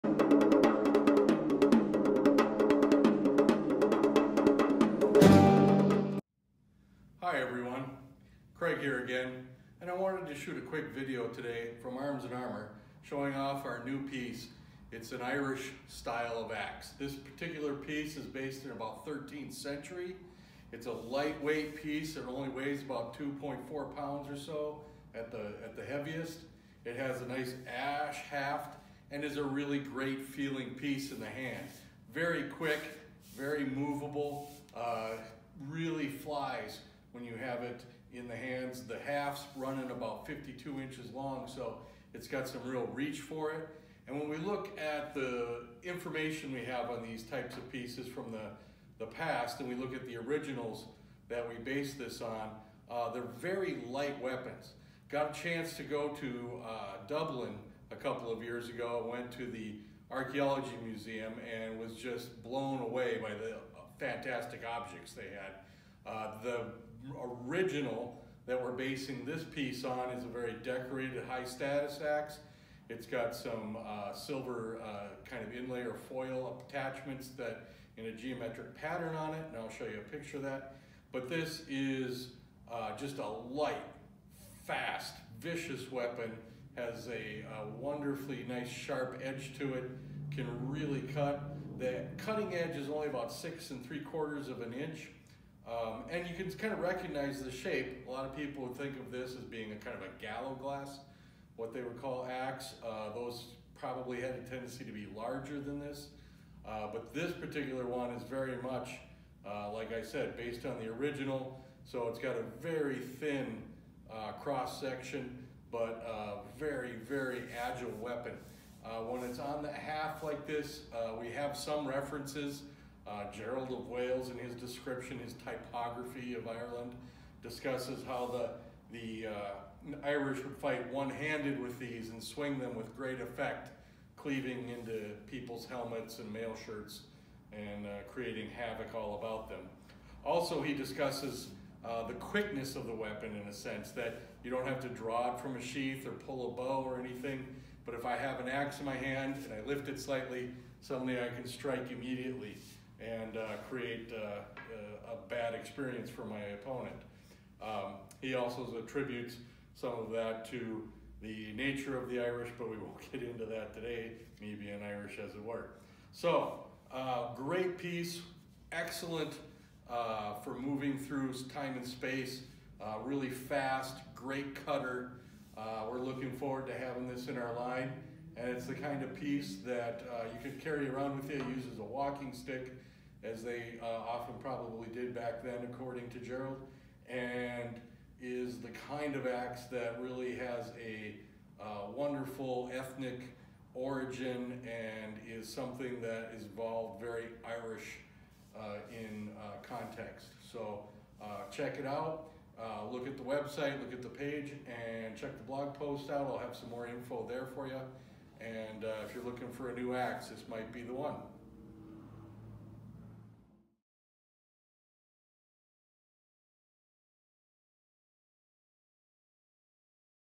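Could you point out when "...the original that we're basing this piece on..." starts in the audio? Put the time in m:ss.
1:06.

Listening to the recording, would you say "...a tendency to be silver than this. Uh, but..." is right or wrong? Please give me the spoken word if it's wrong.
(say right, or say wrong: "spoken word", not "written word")
wrong: "larger", not "silver".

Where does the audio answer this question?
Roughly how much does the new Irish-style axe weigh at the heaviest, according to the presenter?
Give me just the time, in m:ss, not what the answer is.
0:23.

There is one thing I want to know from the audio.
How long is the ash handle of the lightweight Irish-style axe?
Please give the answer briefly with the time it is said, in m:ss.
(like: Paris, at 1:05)
52 inches, at 0:40.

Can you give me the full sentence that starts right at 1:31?
The cutting edge is only about six and three quarters of an inch, um, and you can kind of recognize the shape.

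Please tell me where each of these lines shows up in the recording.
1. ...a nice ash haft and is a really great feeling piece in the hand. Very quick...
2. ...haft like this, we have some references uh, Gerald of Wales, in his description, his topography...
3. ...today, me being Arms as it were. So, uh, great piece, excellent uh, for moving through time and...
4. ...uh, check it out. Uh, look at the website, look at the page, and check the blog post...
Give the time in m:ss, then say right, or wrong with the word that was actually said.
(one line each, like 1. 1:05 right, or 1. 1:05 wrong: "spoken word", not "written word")
1. 0:27 right
2. 1:59 right
3. 2:43 wrong: "Irish", not "Arms"
4. 3:21 right.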